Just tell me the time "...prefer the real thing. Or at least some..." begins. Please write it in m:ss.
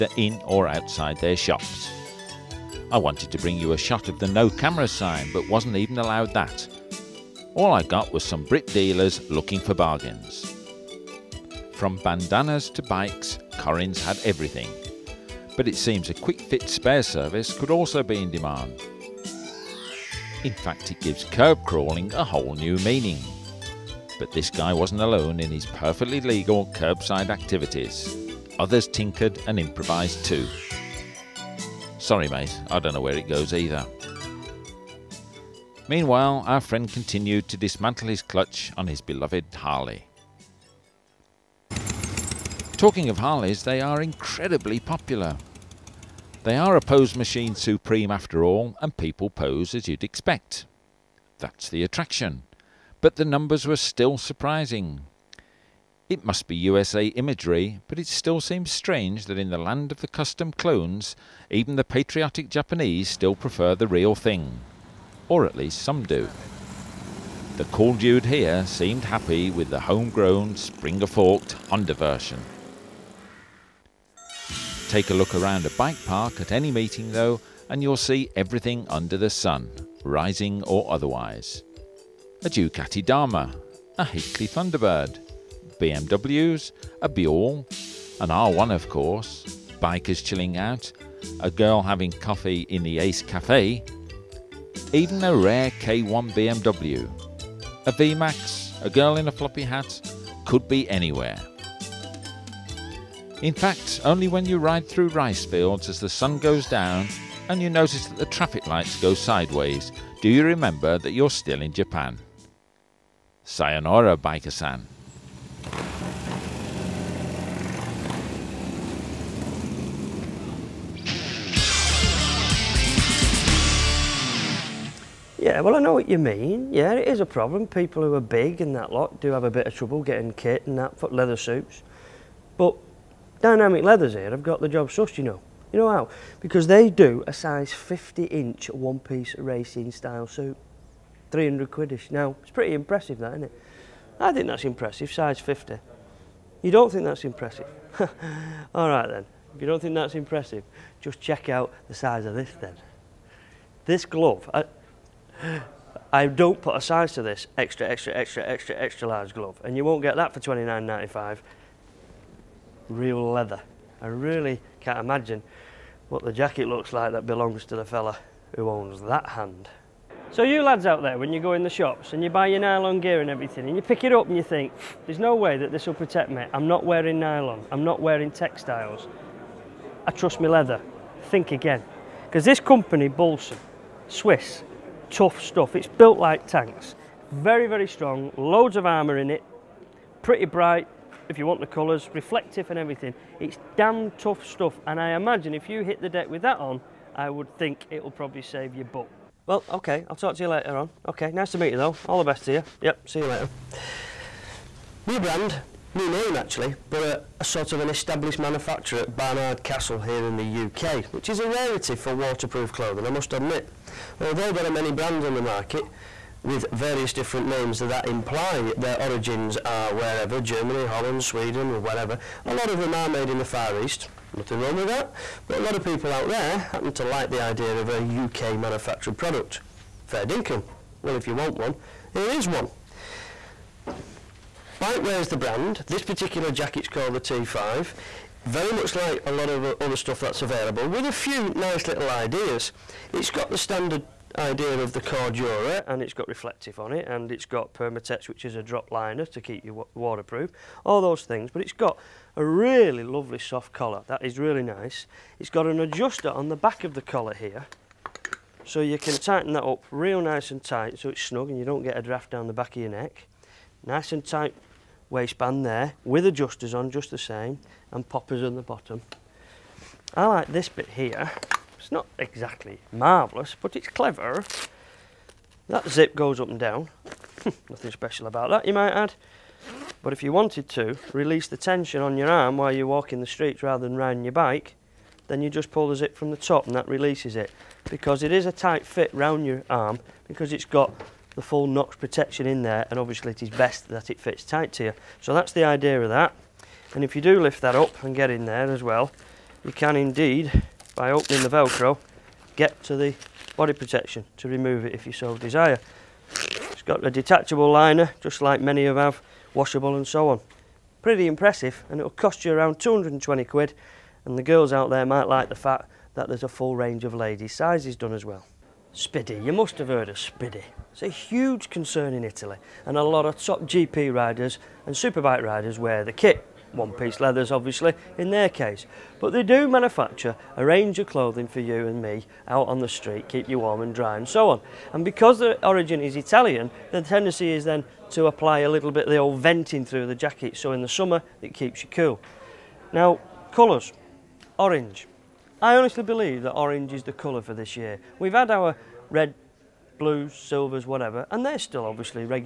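1:03.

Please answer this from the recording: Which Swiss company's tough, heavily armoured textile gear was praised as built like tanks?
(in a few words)
Bolson.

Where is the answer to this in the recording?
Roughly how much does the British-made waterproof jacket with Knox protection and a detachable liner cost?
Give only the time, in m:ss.
5:12.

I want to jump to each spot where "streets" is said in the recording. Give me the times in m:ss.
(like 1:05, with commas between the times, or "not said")
4:43, 5:32.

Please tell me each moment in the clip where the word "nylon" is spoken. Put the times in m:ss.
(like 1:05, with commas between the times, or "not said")
2:52, 2:57.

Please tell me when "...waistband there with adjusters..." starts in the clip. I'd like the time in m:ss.
4:25.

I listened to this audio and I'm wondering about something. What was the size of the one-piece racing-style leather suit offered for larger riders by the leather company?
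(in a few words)
50 inch.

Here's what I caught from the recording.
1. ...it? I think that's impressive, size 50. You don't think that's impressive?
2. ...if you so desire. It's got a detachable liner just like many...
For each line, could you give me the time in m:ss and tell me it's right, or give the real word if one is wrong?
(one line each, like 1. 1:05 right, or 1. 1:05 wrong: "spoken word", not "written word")
1. 2:23 right
2. 5:04 right.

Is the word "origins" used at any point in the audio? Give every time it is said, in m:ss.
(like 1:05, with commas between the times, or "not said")
3:39, 5:35.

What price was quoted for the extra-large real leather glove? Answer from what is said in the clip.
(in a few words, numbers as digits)
29.95.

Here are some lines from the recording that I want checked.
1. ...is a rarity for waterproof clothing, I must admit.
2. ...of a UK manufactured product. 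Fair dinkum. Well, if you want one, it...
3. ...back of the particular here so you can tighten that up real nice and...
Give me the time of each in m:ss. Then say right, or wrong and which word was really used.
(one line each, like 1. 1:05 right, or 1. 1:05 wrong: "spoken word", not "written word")
1. 3:31 right
2. 3:47 right
3. 4:16 wrong: "collar", not "particular".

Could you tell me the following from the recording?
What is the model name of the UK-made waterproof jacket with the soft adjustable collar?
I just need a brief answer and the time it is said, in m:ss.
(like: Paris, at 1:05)
T5, at 3:57.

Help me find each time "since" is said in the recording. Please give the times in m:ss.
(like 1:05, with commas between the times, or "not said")
not said.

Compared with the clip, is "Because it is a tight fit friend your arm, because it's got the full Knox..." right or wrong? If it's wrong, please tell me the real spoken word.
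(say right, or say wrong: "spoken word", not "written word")
wrong: "round", not "friend".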